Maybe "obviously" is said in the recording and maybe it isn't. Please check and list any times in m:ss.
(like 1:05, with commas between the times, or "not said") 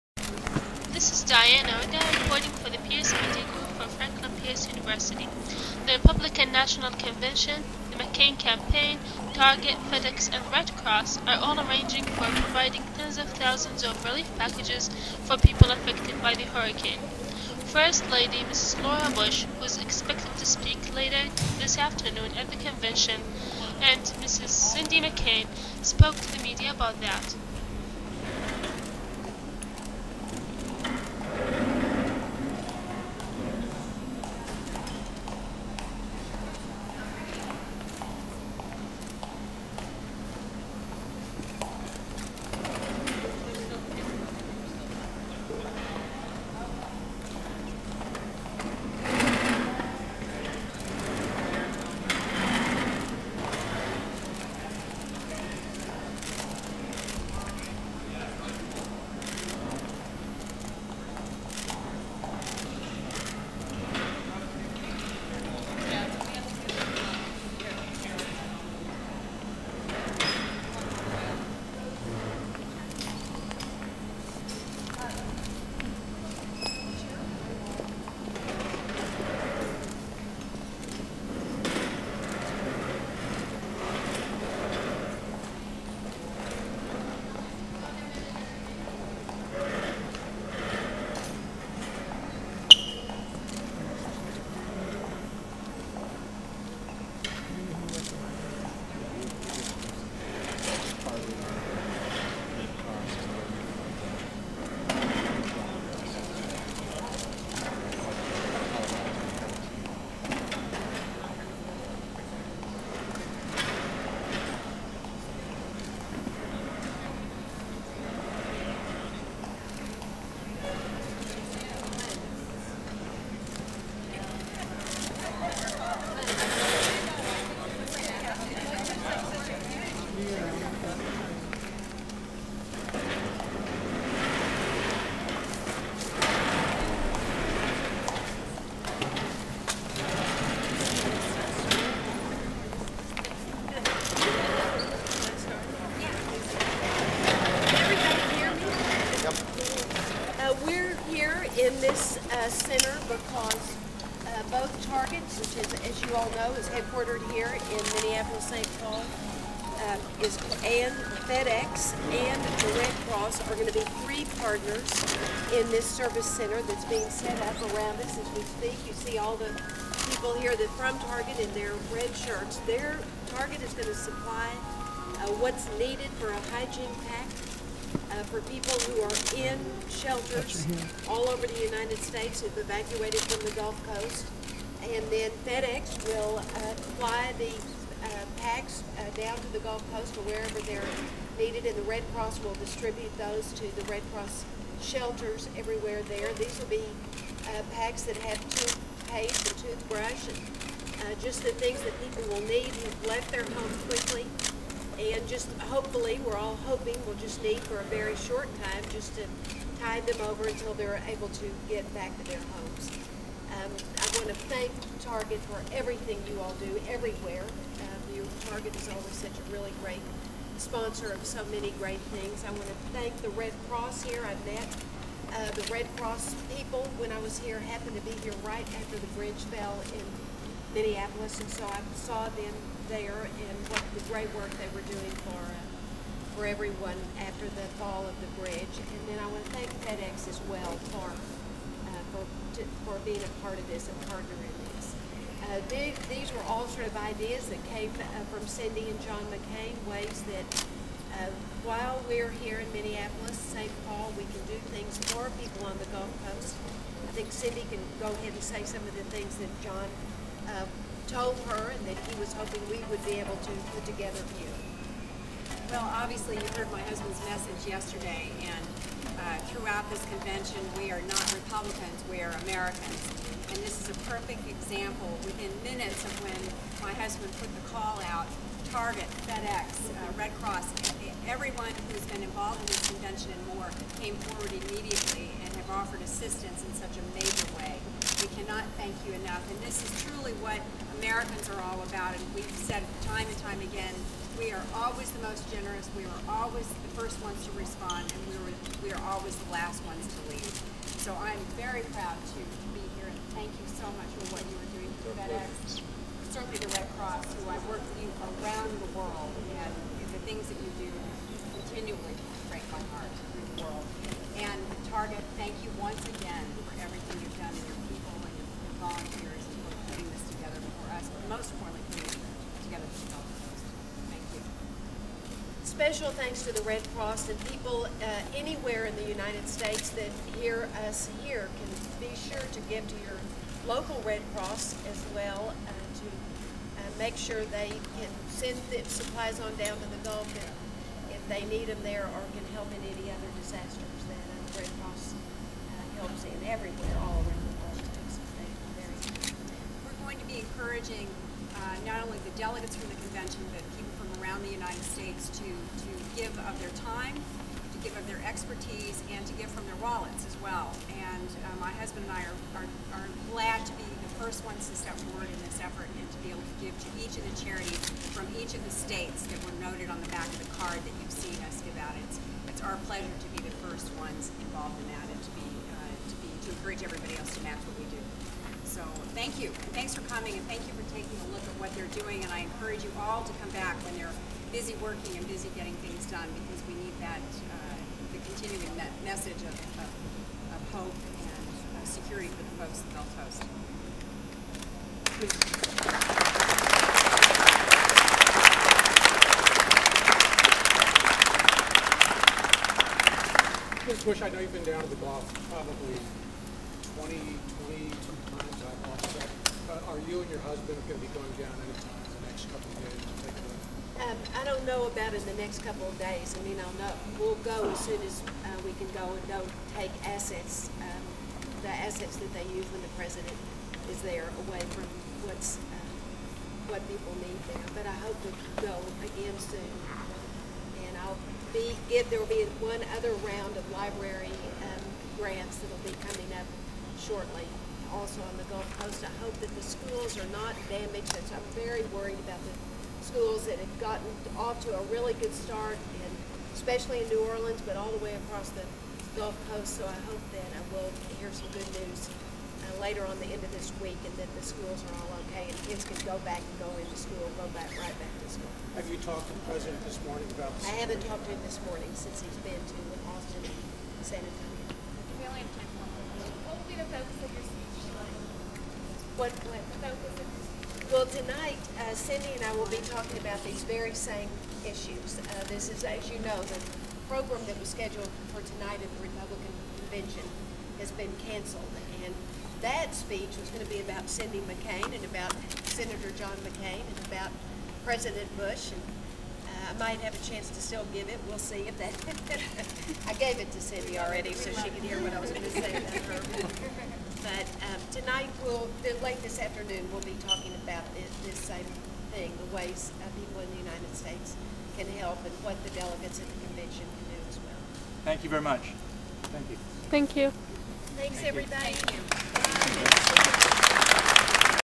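4:25.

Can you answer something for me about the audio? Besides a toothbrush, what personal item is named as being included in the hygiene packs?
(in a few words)
Toothpaste.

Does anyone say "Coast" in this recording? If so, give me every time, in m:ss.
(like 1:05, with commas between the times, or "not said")
3:03, 3:09, 4:16, 5:23, 6:33, 7:18, 7:29.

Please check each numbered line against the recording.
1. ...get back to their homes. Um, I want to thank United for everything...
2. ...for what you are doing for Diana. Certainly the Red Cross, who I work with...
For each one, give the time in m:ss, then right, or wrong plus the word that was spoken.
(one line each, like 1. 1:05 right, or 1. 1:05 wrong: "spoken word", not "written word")
1. 3:31 wrong: "Target", not "United"
2. 5:04 wrong: "FedEx", not "Diana".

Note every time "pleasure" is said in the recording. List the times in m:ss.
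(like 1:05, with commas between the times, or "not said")
6:12.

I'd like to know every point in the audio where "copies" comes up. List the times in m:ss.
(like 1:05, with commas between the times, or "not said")
not said.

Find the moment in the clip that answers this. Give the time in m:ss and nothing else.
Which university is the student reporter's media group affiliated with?
0:03.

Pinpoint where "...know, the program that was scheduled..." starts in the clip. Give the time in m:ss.
7:56.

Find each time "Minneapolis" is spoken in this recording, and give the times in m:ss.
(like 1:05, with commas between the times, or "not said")
2:37, 3:50, 4:12.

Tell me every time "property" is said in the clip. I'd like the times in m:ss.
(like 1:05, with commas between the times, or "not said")
not said.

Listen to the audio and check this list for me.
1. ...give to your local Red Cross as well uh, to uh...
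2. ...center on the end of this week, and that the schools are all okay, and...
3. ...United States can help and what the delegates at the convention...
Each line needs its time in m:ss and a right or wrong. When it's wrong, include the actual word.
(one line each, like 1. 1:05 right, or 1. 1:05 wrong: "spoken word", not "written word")
1. 5:32 right
2. 7:32 wrong: "later", not "center"
3. 8:23 right.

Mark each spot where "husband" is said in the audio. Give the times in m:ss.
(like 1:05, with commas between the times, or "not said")
4:26, 4:36, 6:01, 6:50.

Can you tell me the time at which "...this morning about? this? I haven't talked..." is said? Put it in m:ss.
7:39.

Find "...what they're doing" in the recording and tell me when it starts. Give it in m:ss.
6:21.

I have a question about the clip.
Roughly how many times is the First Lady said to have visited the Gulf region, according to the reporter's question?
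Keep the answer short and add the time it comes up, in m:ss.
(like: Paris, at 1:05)
22, at 6:47.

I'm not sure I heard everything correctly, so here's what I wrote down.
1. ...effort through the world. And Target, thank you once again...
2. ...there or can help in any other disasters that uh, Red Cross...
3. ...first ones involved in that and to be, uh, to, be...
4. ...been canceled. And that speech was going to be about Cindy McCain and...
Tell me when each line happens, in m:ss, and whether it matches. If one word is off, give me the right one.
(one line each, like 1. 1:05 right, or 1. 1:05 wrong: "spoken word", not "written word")
1. 5:12 wrong: "heart", not "effort"
2. 5:41 right
3. 6:13 right
4. 8:00 right.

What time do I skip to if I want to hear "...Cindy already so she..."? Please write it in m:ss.
8:13.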